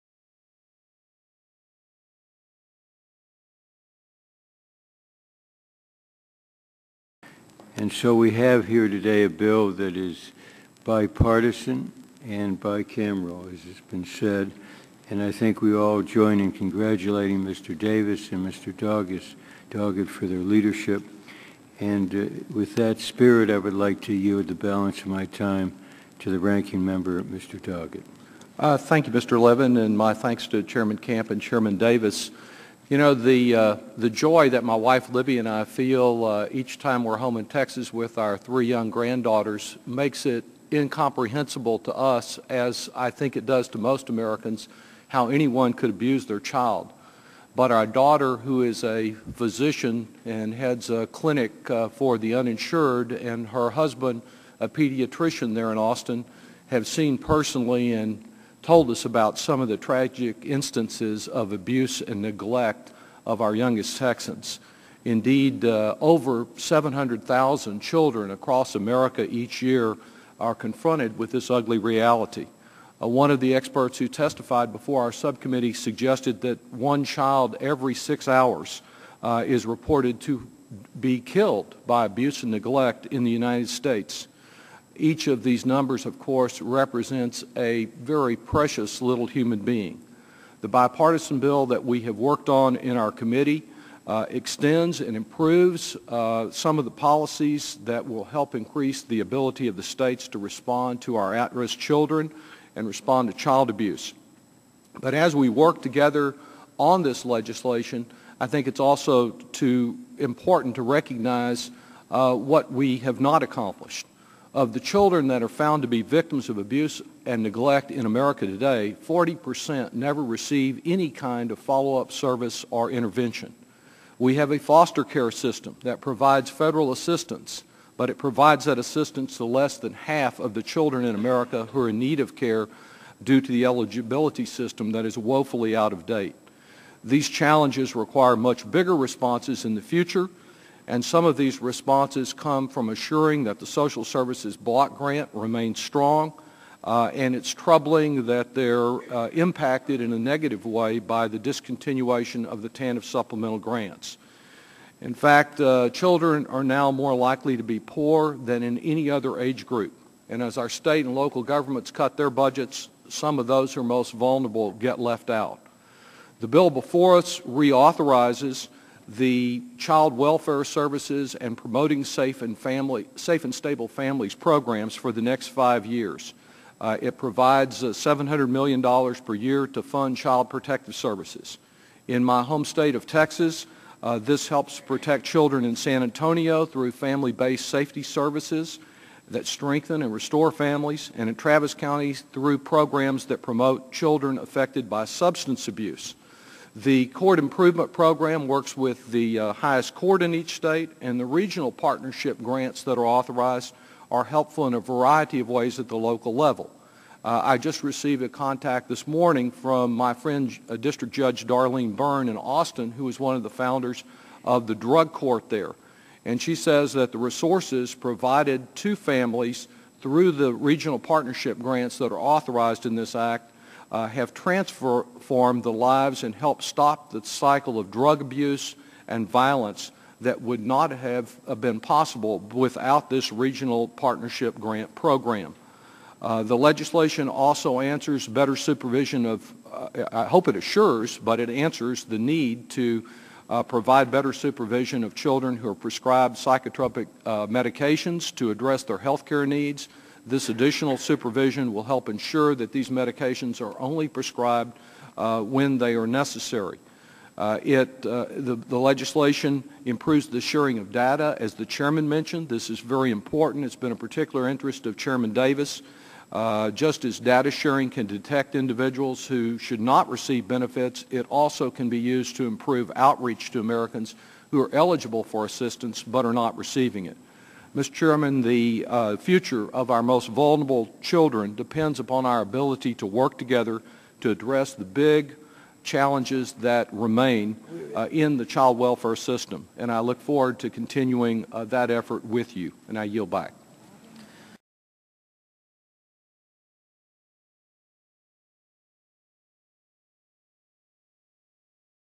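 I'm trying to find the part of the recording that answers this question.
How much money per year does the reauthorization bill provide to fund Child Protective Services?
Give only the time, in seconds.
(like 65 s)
177 s.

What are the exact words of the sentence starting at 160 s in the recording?
And as our state and local governments cut their budgets, some of those who are most vulnerable get left out.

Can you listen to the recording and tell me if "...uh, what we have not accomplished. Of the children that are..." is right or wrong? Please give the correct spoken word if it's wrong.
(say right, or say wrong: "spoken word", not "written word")
right.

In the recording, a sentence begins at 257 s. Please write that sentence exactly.
Uh, it, uh, the, the, legislation improves the sharing of data.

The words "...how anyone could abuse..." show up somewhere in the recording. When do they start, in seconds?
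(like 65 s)
45 s.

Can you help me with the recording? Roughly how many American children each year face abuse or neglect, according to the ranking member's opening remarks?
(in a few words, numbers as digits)
700,000.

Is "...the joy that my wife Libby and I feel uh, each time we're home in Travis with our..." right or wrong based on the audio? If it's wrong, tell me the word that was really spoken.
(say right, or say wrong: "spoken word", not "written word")
wrong: "Texas", not "Travis".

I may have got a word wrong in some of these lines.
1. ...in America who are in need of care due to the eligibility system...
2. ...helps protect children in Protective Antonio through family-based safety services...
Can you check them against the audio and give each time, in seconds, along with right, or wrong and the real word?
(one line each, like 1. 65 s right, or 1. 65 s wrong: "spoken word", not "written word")
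1. 131 s right
2. 184 s wrong: "San", not "Protective".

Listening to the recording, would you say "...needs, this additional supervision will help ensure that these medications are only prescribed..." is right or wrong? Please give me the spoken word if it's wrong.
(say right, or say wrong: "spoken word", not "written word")
right.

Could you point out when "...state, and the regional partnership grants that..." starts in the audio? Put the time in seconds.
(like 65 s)
200 s.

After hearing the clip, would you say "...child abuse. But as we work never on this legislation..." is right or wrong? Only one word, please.
wrong.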